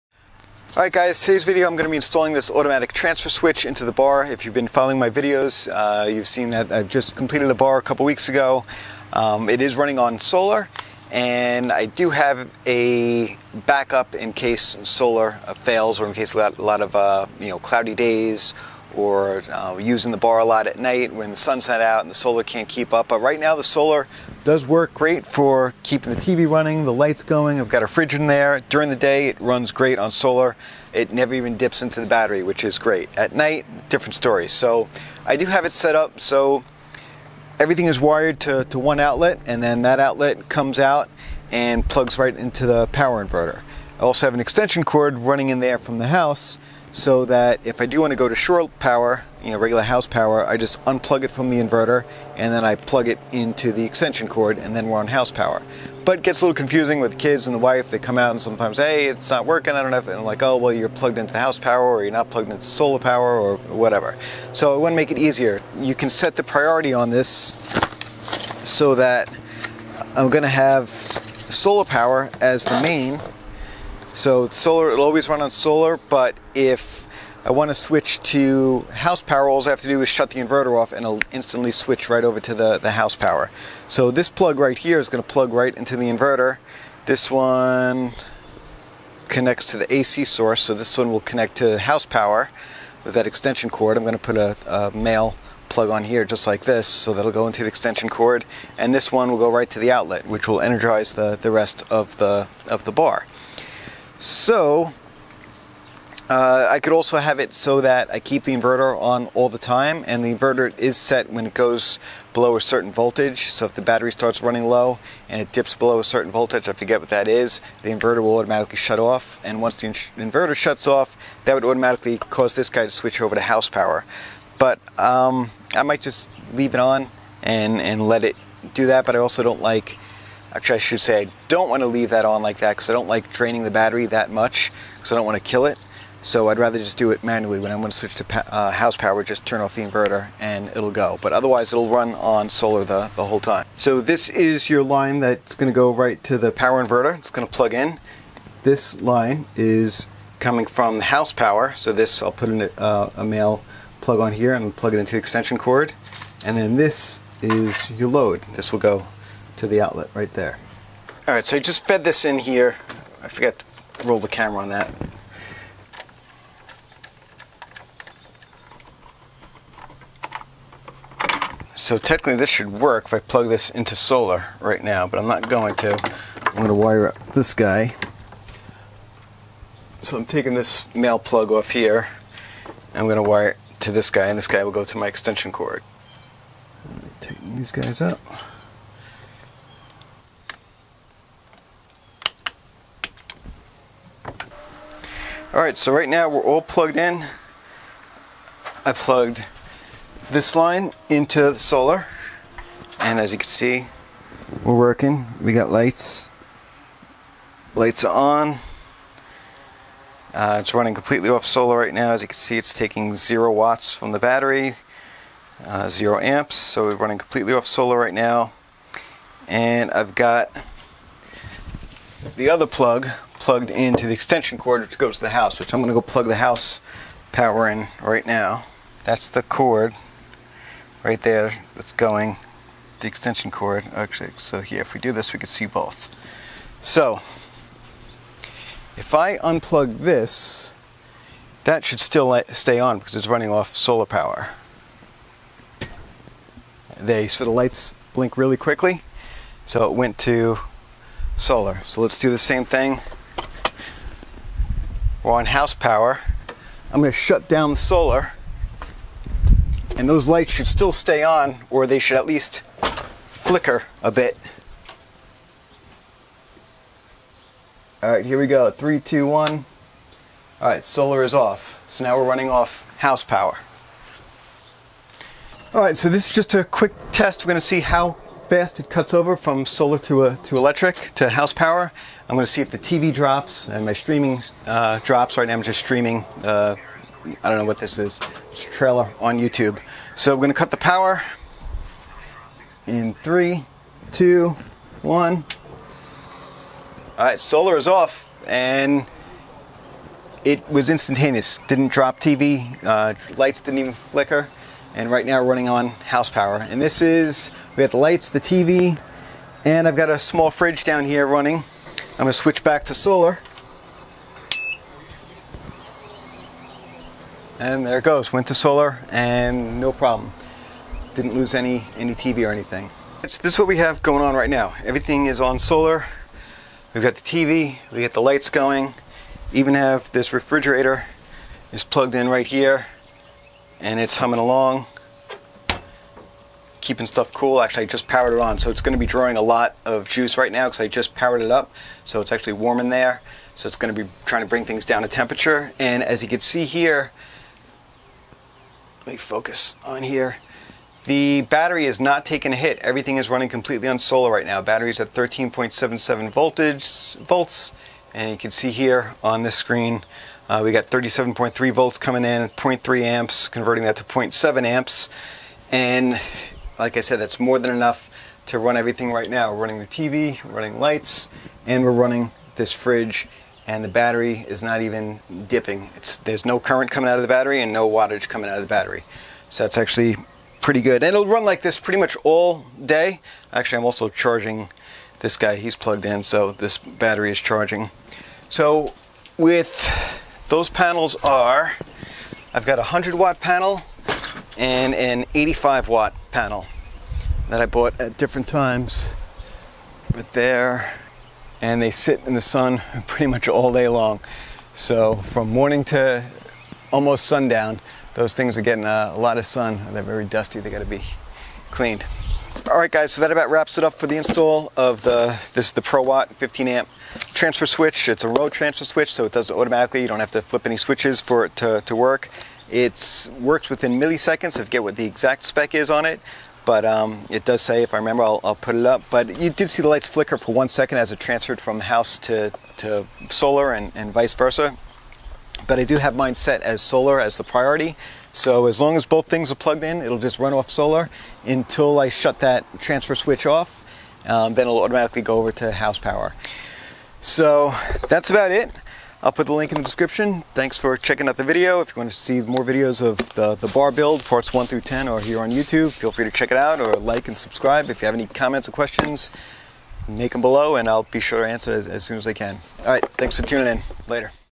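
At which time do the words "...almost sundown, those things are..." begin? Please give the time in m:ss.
6:46.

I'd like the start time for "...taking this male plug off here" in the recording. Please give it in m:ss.
3:00.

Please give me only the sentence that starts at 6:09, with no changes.
We're running the TV, running lights, and we're running this fridge and the battery is not even dipping.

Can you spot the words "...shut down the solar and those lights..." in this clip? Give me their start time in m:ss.
4:17.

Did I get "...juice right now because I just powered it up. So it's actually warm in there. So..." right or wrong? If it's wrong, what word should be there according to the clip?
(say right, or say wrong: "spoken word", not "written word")
right.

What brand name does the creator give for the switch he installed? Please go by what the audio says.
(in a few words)
Prowatt.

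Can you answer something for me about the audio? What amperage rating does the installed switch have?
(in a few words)
15 amp.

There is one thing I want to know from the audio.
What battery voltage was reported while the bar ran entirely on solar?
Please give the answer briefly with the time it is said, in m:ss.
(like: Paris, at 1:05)
13.77 volts, at 5:55.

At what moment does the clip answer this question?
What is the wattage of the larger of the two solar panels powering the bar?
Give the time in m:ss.
6:32.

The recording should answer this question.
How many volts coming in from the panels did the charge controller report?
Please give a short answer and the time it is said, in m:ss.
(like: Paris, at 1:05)
37.3 volts, at 6:00.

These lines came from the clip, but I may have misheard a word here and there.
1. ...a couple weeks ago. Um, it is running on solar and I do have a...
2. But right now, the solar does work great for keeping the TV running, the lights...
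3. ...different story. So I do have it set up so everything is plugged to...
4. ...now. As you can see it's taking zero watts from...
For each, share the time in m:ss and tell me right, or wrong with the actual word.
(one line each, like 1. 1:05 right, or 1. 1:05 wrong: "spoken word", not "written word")
1. 0:07 right
2. 0:23 right
3. 0:33 wrong: "wired", not "plugged"
4. 3:31 right.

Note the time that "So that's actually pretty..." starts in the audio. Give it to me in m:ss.
6:19.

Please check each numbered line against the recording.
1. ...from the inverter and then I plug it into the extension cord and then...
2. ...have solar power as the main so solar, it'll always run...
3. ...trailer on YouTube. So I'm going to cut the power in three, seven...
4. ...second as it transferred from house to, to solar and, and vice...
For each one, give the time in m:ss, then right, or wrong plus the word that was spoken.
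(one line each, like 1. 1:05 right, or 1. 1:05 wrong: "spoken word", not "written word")
1. 0:51 right
2. 1:10 right
3. 4:48 wrong: "two", not "seven"
4. 7:10 right.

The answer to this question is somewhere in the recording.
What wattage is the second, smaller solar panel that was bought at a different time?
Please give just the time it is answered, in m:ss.
6:35.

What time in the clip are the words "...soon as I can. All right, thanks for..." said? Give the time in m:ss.
7:42.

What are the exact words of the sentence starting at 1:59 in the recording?
And once the in inverter shuts off, that would automatically cause this guy to switch over to house power.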